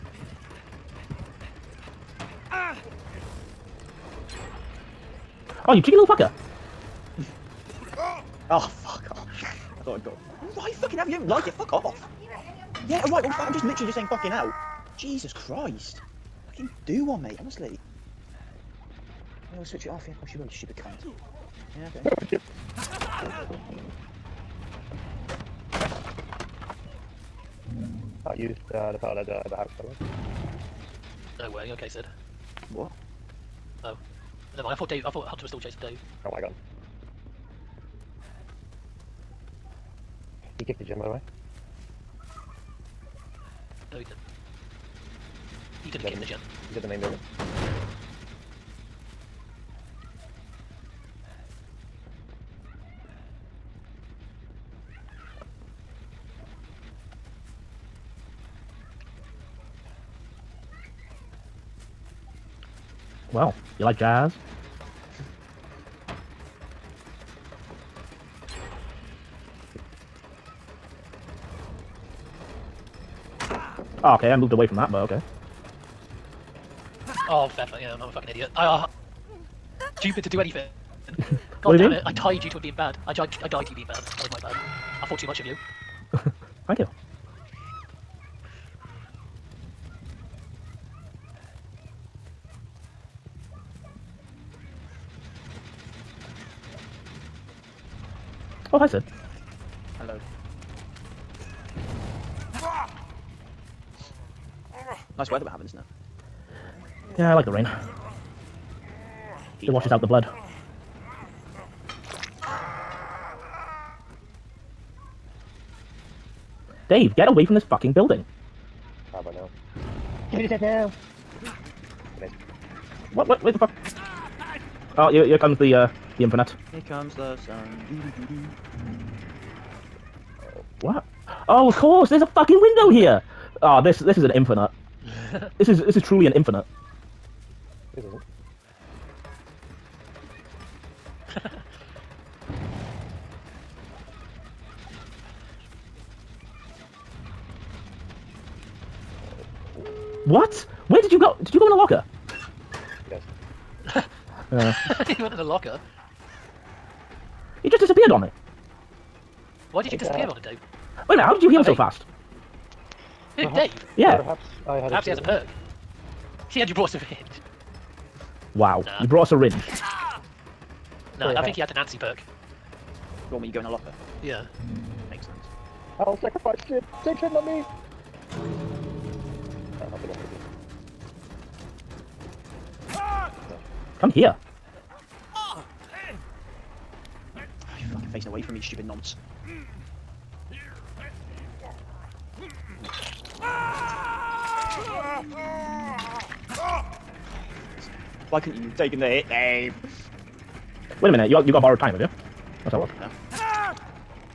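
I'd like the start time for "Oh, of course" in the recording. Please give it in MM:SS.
02:11.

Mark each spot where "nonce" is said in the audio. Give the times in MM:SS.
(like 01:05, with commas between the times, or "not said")
03:08.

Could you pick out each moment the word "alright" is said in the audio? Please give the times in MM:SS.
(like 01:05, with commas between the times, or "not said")
00:13.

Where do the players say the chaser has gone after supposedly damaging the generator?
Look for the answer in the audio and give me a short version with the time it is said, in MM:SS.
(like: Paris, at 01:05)
Main building, at 00:46.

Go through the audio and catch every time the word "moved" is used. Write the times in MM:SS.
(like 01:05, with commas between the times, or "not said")
01:14.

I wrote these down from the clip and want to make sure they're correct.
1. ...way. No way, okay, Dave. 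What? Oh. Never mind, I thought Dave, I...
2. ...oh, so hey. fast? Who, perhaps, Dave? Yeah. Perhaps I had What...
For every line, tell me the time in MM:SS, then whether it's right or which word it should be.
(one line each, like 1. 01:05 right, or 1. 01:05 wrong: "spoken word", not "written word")
1. 00:29 wrong: "Sid", not "Dave"
2. 02:41 wrong: "Perhaps", not "What".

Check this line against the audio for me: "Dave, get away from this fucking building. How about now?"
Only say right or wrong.
right.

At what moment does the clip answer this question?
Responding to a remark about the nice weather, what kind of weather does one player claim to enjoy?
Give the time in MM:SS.
01:47.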